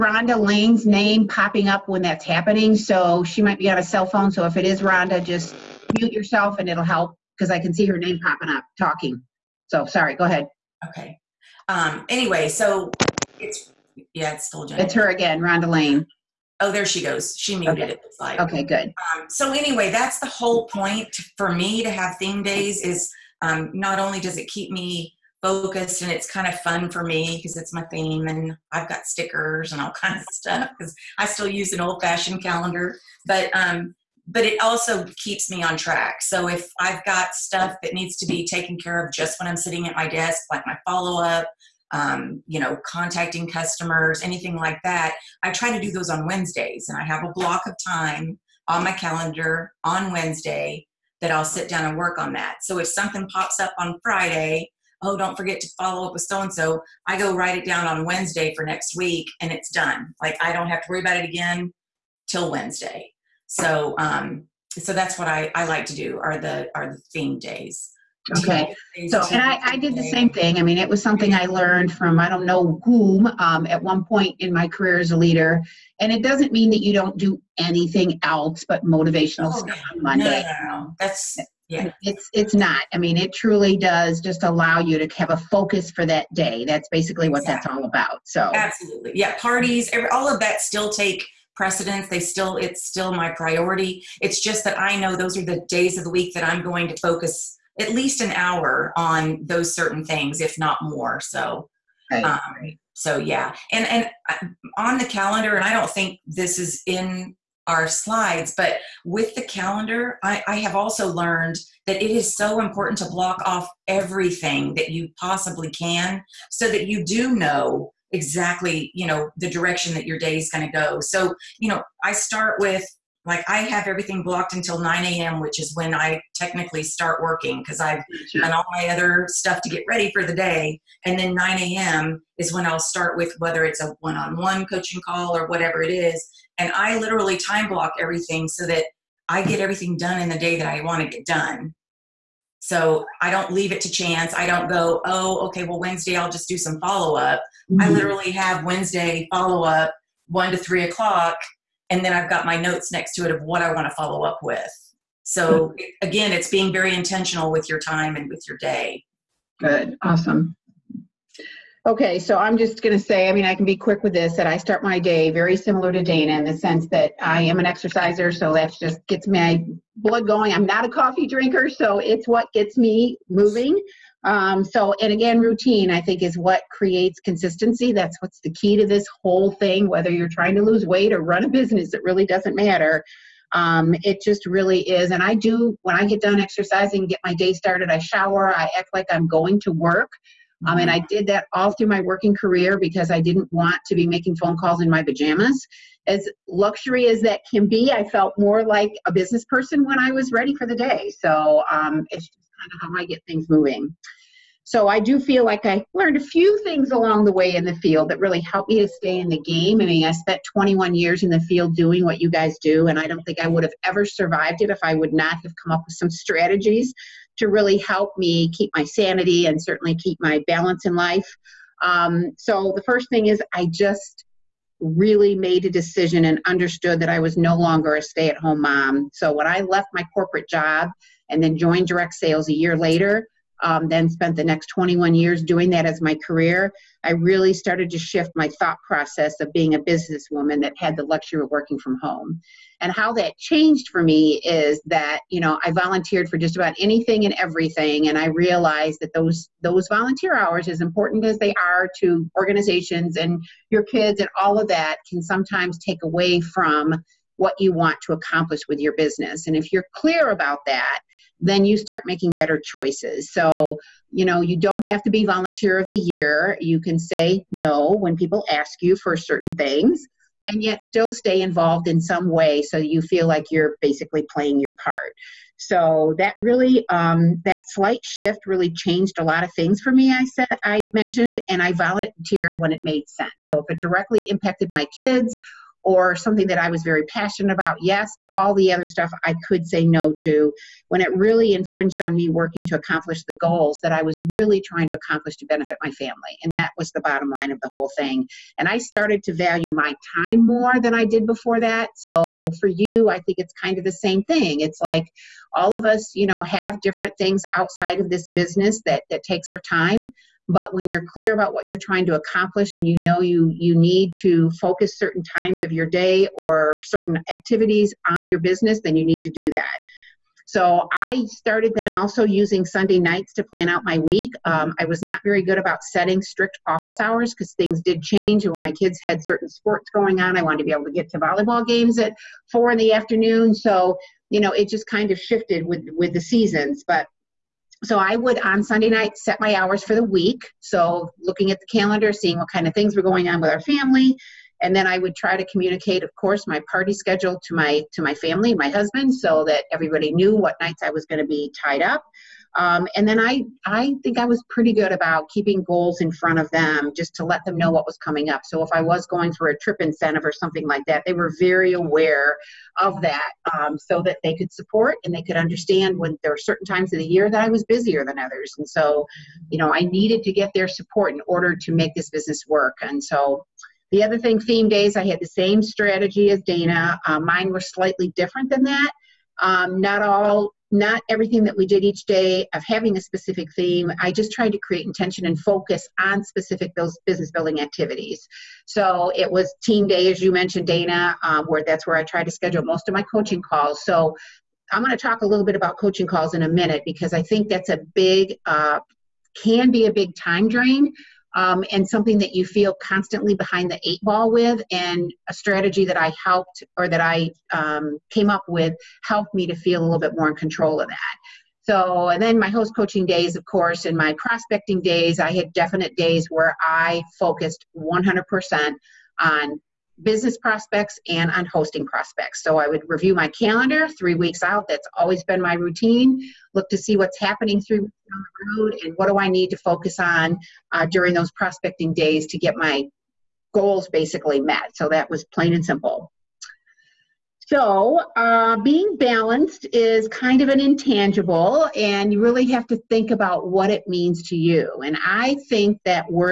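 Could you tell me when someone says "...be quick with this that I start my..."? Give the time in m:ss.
2:43.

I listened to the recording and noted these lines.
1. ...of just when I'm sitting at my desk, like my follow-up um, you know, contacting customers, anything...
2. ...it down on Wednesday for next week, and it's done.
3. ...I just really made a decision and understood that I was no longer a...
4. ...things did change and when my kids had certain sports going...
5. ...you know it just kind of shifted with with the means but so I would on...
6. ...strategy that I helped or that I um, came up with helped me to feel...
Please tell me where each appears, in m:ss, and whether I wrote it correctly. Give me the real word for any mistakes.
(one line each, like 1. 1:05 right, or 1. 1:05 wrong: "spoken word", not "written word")
1. 0:39 right
2. 0:57 right
3. 3:43 right
4. 5:27 right
5. 5:34 wrong: "seasons", not "means"
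6. 6:45 right.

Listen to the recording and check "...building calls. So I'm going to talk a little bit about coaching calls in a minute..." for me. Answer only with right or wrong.
wrong.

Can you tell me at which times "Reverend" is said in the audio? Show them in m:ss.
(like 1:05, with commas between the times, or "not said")
not said.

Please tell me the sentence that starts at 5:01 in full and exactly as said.
So for you, I think it's kind of the same thing.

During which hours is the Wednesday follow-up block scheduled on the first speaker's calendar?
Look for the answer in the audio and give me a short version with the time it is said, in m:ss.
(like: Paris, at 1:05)
1 to 3, at 2:30.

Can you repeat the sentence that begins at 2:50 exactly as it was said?
I'm not a coffee drinker, so it's what gets me moving.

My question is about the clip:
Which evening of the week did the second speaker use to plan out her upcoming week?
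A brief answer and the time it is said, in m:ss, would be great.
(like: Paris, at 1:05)
Sunday night, at 5:22.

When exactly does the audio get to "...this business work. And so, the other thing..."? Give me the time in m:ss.
6:11.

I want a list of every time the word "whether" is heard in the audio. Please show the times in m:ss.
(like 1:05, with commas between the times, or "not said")
2:13, 2:59.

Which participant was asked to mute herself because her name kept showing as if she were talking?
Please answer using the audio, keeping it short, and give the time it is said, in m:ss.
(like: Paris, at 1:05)
Rhonda Lane, at 0:15.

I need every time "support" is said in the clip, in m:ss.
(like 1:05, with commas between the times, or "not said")
6:04, 6:10.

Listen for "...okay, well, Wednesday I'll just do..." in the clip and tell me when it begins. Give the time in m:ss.
2:25.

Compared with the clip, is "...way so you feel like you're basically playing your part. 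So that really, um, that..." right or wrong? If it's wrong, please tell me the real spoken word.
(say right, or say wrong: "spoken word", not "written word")
right.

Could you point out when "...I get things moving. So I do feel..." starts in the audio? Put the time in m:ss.
3:23.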